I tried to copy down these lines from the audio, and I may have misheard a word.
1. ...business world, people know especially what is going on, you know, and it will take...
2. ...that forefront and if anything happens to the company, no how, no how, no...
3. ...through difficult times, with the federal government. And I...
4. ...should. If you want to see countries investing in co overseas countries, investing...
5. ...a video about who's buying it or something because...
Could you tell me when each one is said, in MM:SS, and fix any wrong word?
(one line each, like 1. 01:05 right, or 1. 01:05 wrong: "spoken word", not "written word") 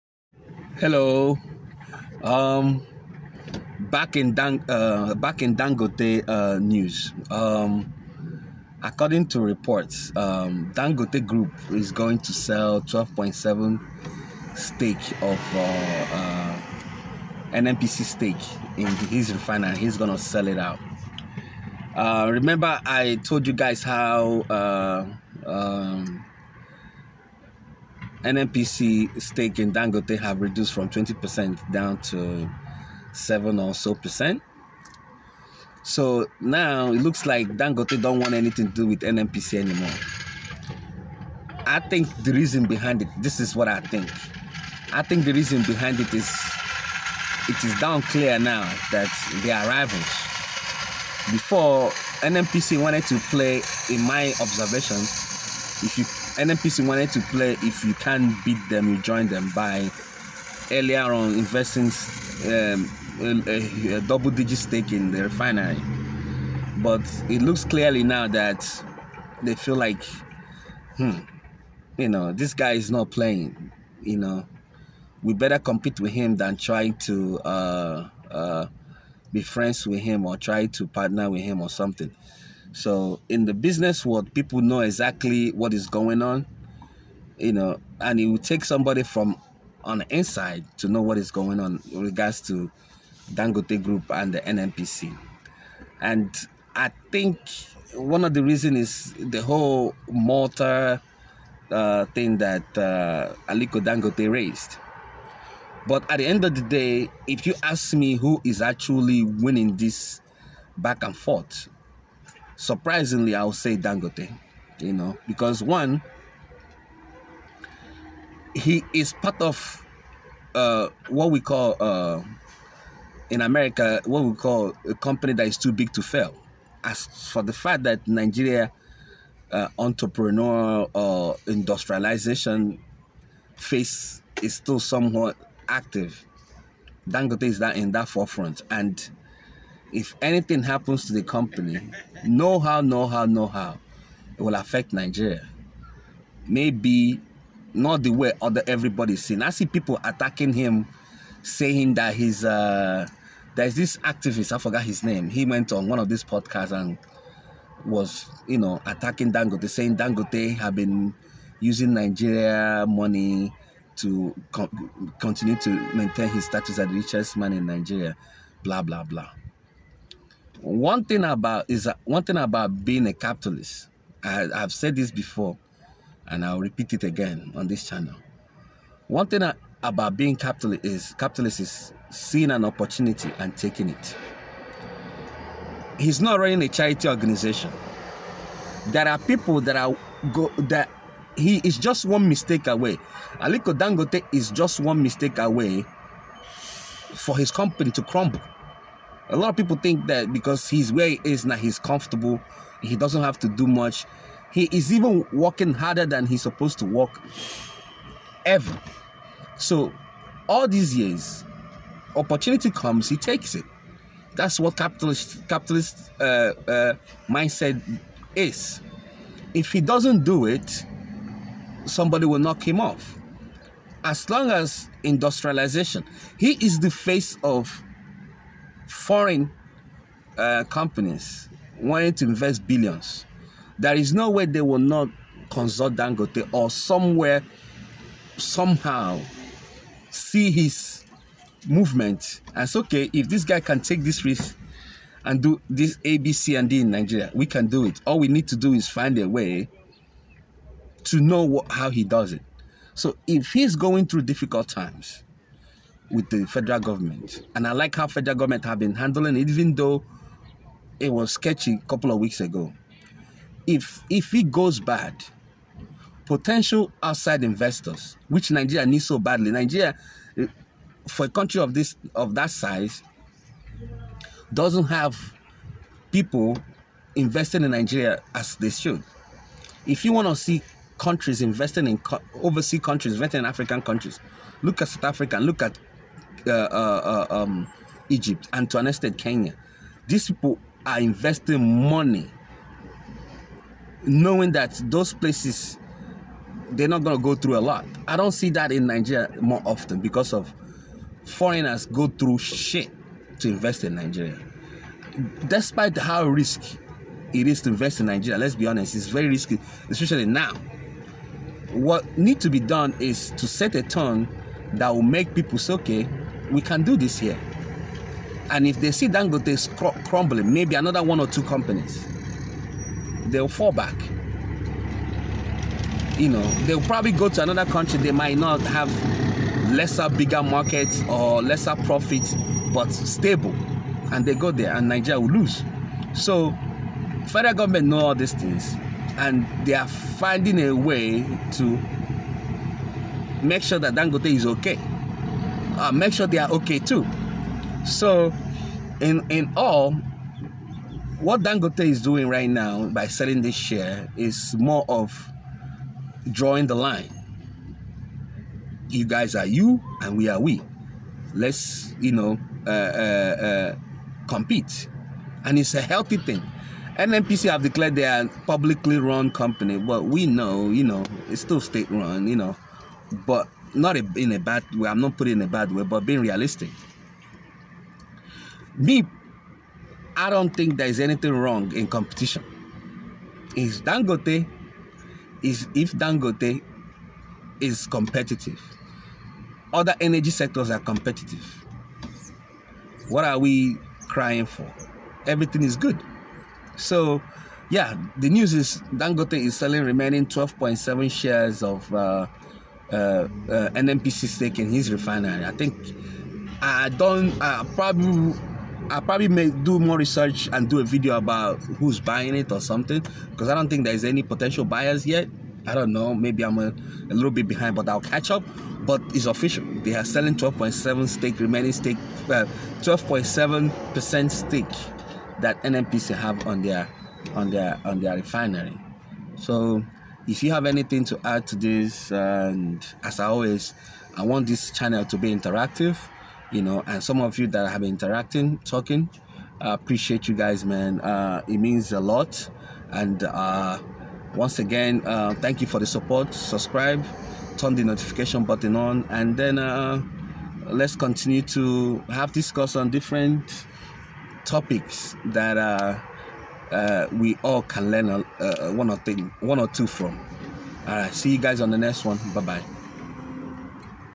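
1. 01:23 wrong: "exactly", not "especially"
2. 02:17 right
3. 04:14 right
4. 04:38 right
5. 06:50 right.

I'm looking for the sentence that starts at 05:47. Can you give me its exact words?
So, in in all, what Dangote is doing right now by selling this share is more of drawing the line.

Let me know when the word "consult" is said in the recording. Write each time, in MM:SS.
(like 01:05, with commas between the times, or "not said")
03:55.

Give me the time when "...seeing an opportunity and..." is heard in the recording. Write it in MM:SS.
03:02.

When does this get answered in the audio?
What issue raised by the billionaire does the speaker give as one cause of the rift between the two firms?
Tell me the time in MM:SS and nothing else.
01:40.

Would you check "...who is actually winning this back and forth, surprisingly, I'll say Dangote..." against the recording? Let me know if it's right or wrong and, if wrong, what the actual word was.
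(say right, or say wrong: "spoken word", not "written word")
right.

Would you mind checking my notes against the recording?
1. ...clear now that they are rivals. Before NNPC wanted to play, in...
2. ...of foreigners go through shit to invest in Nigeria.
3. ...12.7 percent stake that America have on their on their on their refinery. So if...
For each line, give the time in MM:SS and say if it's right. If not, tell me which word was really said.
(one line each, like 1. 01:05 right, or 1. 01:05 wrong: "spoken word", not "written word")
1. 00:48 right
2. 05:00 right
3. 07:02 wrong: "NNPC", not "America".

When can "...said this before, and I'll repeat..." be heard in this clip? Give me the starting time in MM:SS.
02:54.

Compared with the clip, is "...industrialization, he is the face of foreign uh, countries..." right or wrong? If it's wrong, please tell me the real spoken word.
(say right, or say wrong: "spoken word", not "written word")
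wrong: "companies", not "countries".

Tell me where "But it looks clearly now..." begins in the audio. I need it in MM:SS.
01:06.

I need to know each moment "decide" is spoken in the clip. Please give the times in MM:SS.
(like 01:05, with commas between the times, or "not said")
not said.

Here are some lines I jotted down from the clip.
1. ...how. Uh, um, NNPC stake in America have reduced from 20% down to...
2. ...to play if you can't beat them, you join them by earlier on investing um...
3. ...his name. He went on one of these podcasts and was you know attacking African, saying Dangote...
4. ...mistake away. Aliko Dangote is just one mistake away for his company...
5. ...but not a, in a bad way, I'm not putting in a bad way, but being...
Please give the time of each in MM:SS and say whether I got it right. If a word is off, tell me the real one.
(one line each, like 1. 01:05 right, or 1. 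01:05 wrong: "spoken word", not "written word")
1. 00:23 wrong: "Dangote", not "America"
2. 00:57 right
3. 02:34 wrong: "Dangote", not "African"
4. 03:12 right
5. 06:13 right.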